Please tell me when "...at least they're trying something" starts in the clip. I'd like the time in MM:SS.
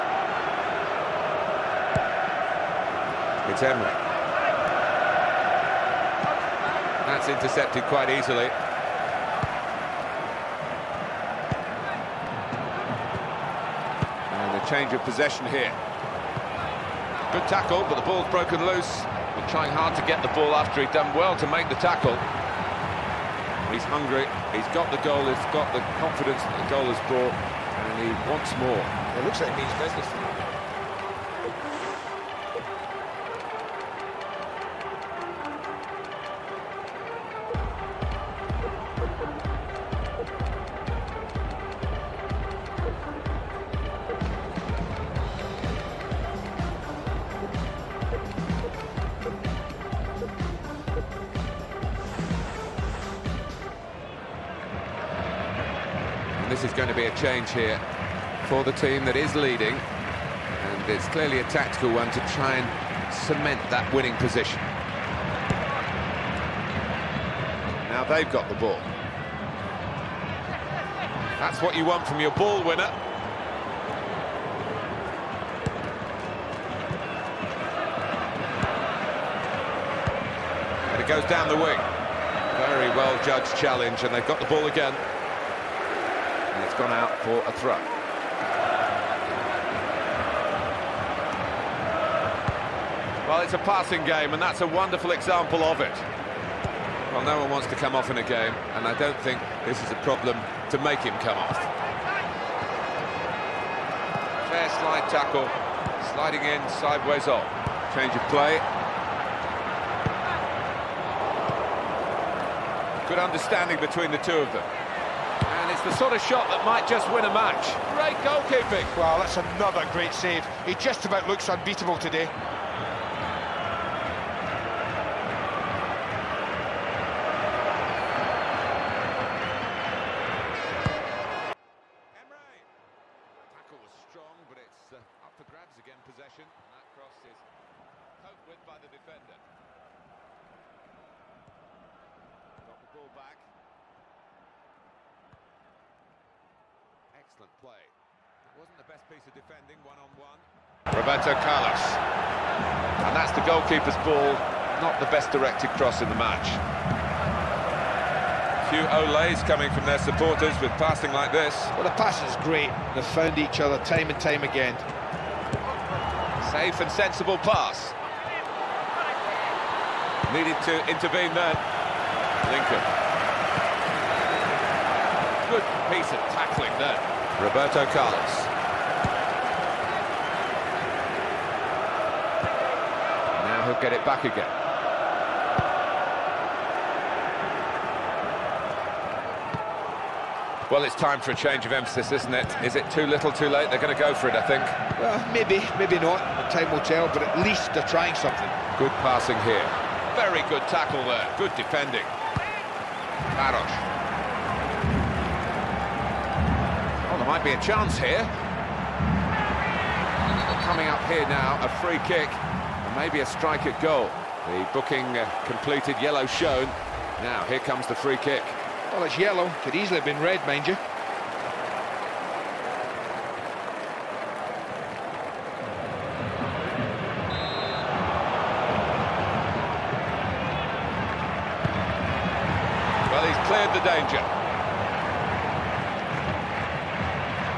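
03:17.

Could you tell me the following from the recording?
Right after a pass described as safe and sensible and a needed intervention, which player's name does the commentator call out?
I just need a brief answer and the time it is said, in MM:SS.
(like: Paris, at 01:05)
Lincoln, at 02:52.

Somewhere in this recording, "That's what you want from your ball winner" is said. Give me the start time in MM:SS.
01:11.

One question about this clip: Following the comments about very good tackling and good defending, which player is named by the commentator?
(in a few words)
Baros.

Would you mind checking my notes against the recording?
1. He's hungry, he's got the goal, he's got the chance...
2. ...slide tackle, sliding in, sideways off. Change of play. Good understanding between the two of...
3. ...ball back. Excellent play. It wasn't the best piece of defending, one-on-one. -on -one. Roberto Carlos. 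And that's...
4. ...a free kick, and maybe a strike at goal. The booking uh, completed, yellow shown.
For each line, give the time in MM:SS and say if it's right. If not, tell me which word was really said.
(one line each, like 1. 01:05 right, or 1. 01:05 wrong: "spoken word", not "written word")
1. 00:23 wrong: "confidence", not "chance"
2. 01:44 right
3. 02:22 right
4. 03:31 right.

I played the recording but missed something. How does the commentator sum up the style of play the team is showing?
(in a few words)
passing game.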